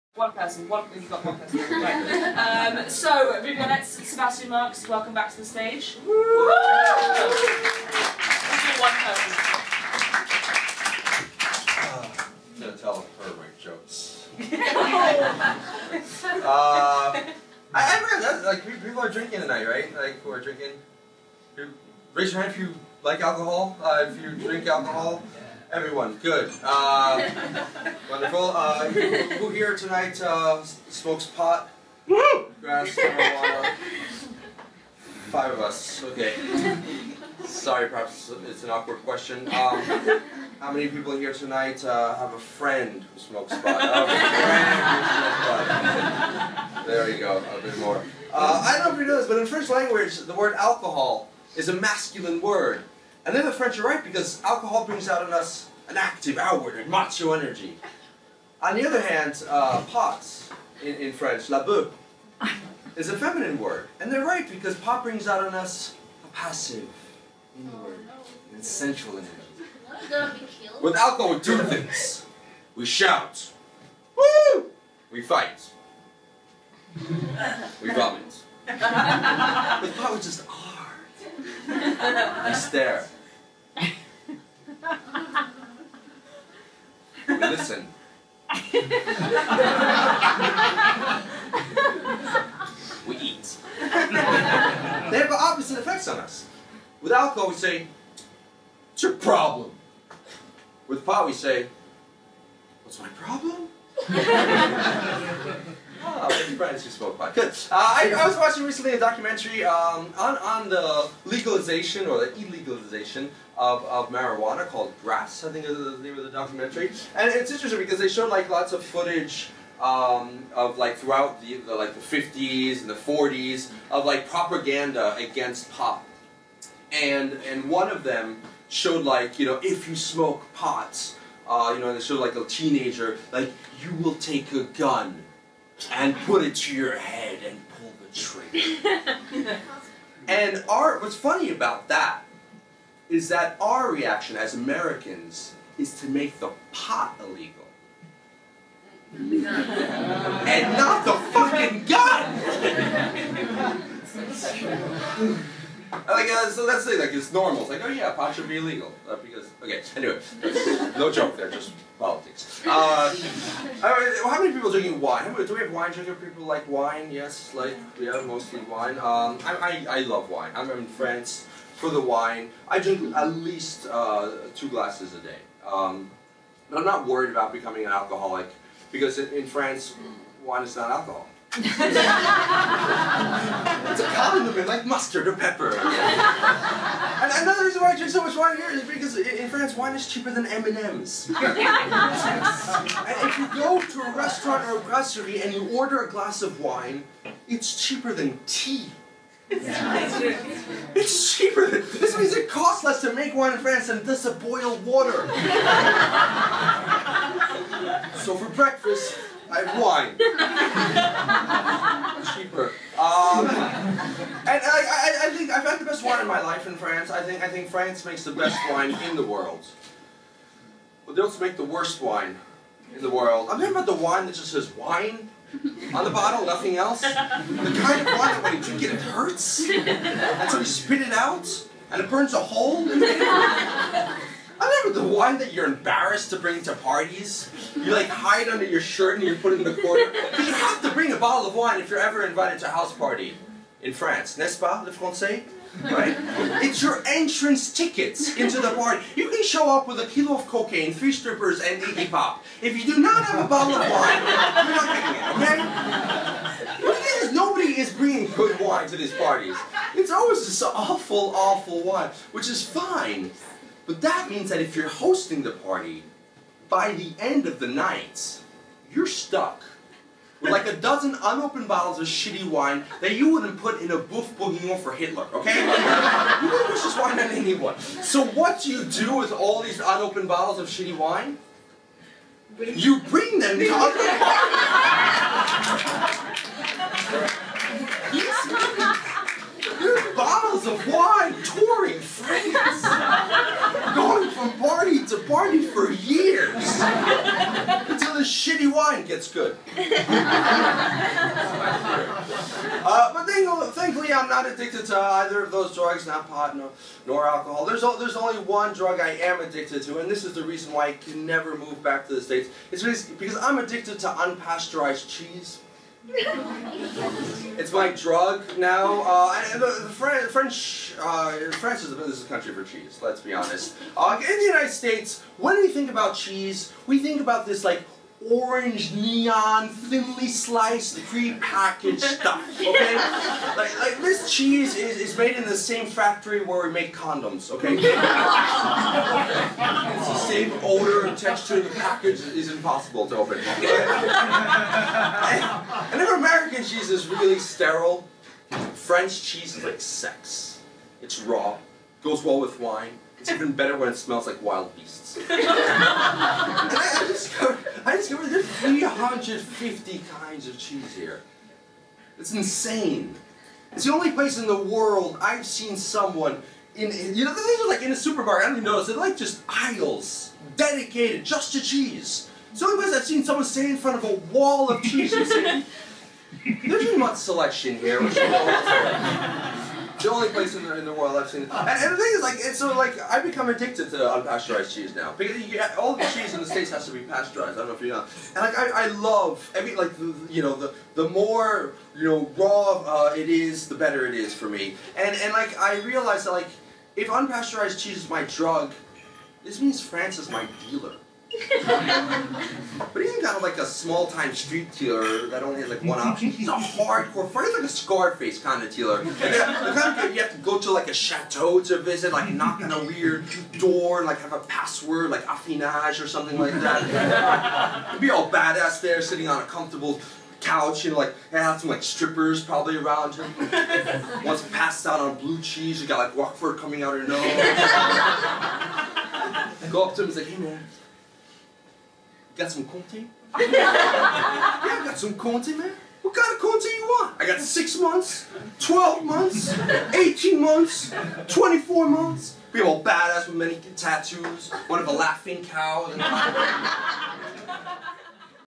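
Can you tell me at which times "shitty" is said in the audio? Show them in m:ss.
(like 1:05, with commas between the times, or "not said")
4:32, 4:40, 4:58.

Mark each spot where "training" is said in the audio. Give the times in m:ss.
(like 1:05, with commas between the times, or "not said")
not said.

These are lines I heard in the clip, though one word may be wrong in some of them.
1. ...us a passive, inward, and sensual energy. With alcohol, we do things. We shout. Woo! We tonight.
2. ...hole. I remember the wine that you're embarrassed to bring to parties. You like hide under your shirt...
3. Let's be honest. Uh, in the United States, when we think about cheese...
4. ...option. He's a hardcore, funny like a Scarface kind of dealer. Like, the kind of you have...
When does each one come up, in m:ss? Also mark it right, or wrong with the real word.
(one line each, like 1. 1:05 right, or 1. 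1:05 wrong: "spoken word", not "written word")
1. 1:05 wrong: "fight", not "tonight"
2. 3:52 right
3. 5:23 right
4. 6:45 right.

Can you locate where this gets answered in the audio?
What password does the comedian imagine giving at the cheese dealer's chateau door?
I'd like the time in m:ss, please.
6:55.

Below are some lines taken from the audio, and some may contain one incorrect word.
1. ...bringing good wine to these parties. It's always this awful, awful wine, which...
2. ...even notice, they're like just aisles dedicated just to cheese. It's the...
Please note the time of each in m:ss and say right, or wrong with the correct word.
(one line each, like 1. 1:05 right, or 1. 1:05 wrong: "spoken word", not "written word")
1. 4:17 right
2. 6:08 right.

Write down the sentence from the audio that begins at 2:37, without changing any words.
It's like, oh yeah, pot should be illegal.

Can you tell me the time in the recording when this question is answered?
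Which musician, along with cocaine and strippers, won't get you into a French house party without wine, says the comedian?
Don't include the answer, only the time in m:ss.
4:11.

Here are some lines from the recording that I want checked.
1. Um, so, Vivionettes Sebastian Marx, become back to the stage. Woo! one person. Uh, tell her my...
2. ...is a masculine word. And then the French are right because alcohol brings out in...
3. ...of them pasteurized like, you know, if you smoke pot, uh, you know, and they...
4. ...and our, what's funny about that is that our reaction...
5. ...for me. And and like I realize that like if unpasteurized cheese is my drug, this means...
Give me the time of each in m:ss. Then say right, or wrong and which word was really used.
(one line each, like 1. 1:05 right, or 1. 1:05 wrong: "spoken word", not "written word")
1. 0:02 wrong: "welcome", not "become"
2. 0:51 right
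3. 2:07 wrong: "showed", not "pasteurized"
4. 2:20 right
5. 6:34 right.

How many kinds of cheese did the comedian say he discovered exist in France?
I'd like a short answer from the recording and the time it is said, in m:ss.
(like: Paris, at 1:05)
350, at 5:58.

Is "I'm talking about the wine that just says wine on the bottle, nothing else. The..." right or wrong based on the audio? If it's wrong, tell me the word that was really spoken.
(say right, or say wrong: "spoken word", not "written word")
right.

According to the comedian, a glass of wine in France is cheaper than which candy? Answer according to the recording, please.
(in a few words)
M&Ms.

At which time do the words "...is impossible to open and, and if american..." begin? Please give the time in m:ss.
5:42.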